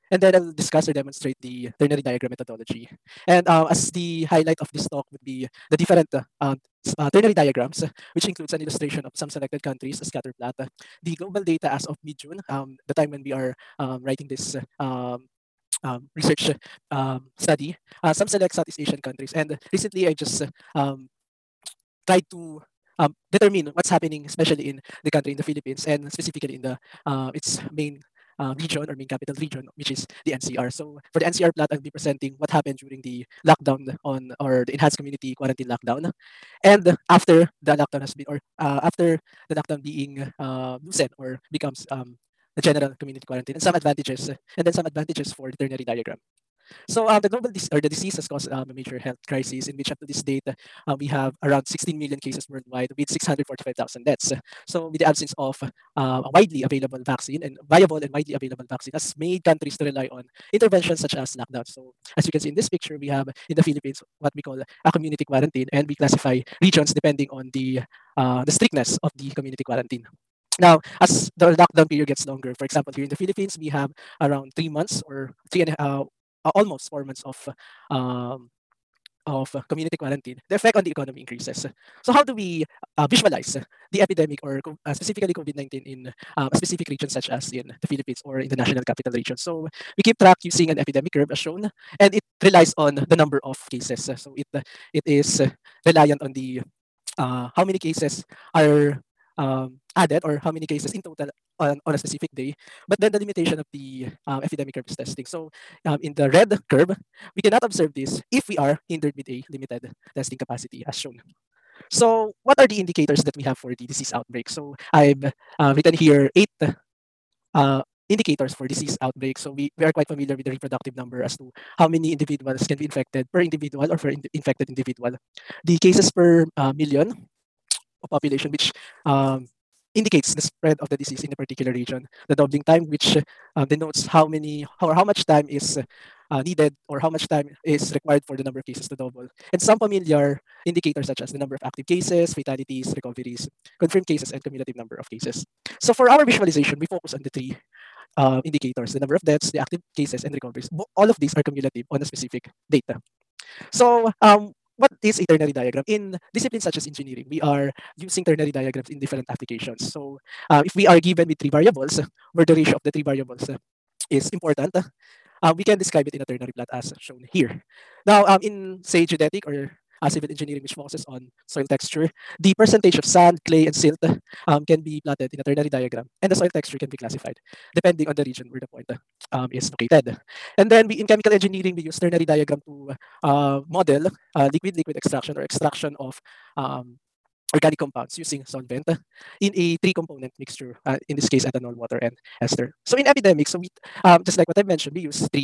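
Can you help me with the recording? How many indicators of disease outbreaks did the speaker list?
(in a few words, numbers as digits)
8.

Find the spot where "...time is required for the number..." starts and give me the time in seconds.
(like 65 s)
137 s.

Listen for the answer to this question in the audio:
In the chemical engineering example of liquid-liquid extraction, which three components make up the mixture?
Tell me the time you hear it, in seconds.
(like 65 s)
191 s.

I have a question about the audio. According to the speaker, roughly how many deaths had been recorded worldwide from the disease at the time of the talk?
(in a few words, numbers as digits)
645,000.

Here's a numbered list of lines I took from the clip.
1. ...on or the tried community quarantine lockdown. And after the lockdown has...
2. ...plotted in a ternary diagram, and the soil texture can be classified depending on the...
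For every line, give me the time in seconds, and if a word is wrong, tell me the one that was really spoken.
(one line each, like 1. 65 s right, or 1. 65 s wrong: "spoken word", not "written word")
1. 34 s wrong: "enhanced", not "tried"
2. 175 s right.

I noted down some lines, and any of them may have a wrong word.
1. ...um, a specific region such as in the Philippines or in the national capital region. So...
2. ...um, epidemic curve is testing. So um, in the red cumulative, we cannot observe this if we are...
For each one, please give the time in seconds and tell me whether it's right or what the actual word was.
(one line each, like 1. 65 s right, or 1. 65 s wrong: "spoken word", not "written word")
1. 86 s right
2. 104 s wrong: "curve", not "cumulative".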